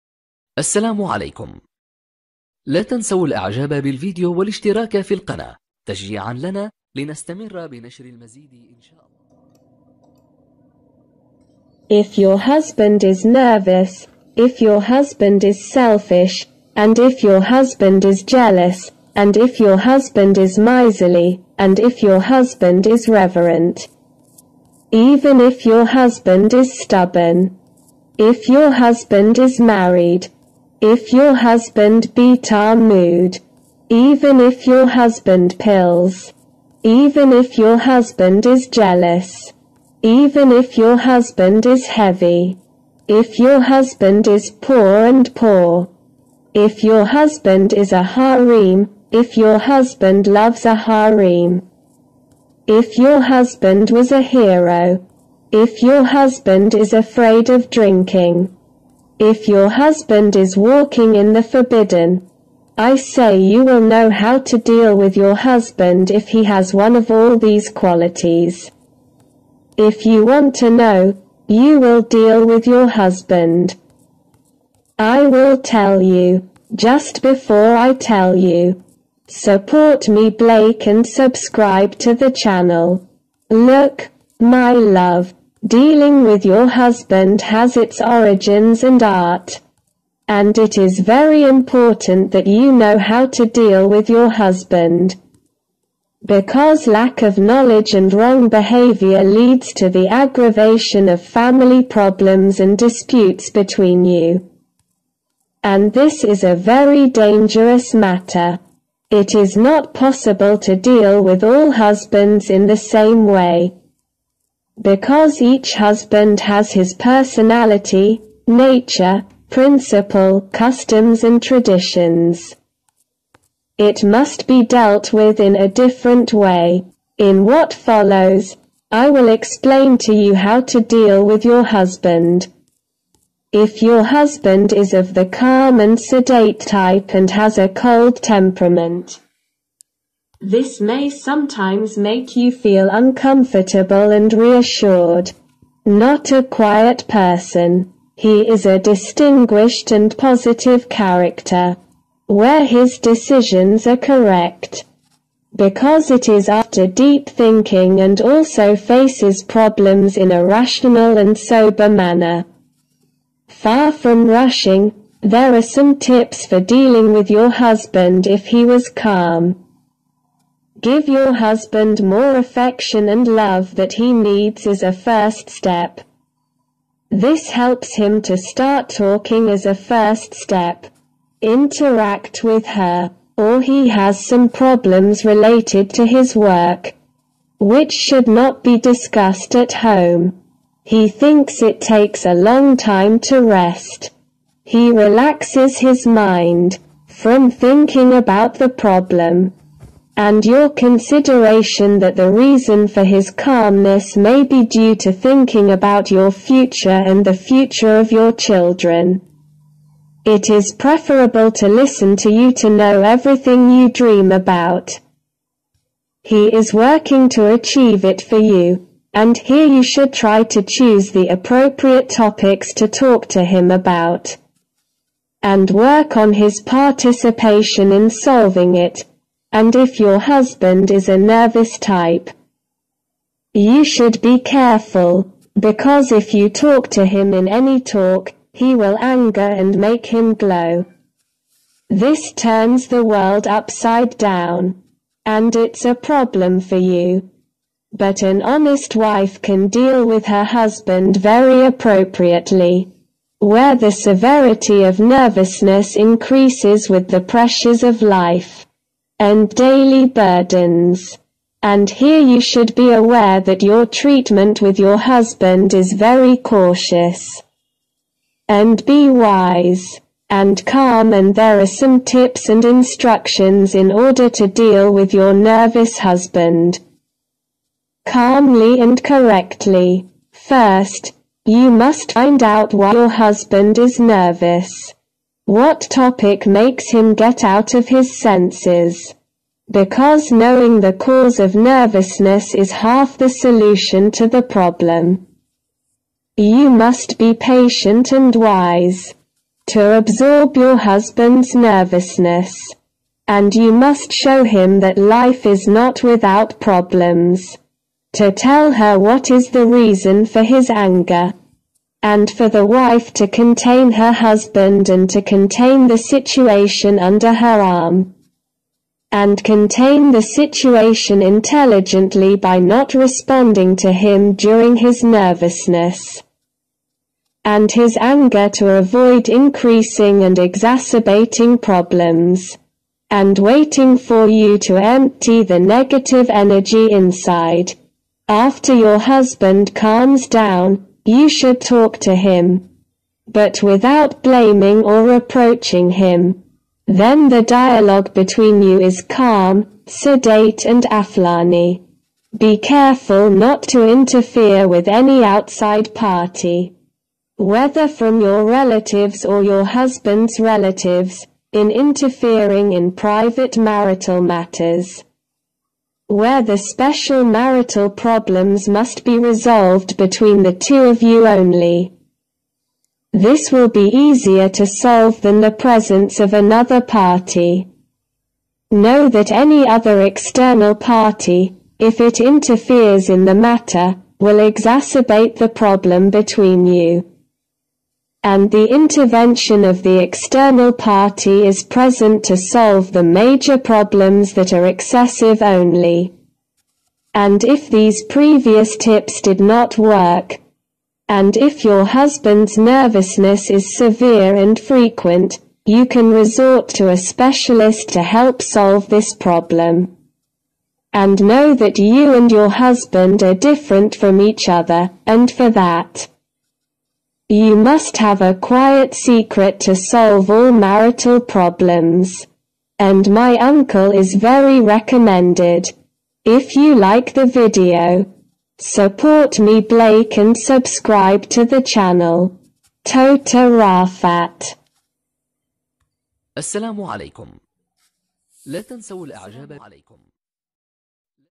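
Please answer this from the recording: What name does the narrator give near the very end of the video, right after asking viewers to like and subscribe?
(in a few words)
Tota Rafat.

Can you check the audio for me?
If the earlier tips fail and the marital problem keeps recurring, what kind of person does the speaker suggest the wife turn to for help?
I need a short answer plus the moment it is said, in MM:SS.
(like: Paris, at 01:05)
A specialist, at 06:46.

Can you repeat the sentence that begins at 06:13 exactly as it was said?
This will be easier to solve than the presence of another party.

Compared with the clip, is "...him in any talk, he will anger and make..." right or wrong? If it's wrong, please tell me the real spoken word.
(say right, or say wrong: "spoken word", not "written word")
right.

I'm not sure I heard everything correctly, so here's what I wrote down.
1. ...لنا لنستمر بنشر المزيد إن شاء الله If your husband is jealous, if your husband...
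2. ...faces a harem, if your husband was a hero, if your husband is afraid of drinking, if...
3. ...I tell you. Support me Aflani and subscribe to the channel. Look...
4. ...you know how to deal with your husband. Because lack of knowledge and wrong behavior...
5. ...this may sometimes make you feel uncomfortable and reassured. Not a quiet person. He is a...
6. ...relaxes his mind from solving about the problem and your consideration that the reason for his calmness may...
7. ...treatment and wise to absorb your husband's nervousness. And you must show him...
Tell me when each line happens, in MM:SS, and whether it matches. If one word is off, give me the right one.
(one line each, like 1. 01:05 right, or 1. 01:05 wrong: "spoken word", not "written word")
1. 00:06 wrong: "nervous", not "jealous"
2. 00:50 wrong: "loves", not "faces"
3. 01:17 wrong: "Blake", not "Aflani"
4. 01:32 right
5. 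02:20 right
6. 03:14 wrong: "thinking", not "solving"
7. 04:57 wrong: "patient", not "treatment".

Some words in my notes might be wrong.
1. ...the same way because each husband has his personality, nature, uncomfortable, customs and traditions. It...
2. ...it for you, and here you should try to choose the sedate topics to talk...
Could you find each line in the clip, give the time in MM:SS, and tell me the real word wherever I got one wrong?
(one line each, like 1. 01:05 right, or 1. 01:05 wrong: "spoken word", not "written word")
1. 01:52 wrong: "principle", not "uncomfortable"
2. 03:38 wrong: "appropriate", not "sedate".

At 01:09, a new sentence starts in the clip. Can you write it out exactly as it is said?
If you want to know, you will deal with your husband.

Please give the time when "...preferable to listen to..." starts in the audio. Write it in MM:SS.
03:30.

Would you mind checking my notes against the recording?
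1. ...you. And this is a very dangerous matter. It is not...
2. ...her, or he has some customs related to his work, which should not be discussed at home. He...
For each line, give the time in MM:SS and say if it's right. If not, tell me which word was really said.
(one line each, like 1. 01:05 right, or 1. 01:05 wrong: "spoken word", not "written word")
1. 01:44 right
2. 03:02 wrong: "problems", not "customs".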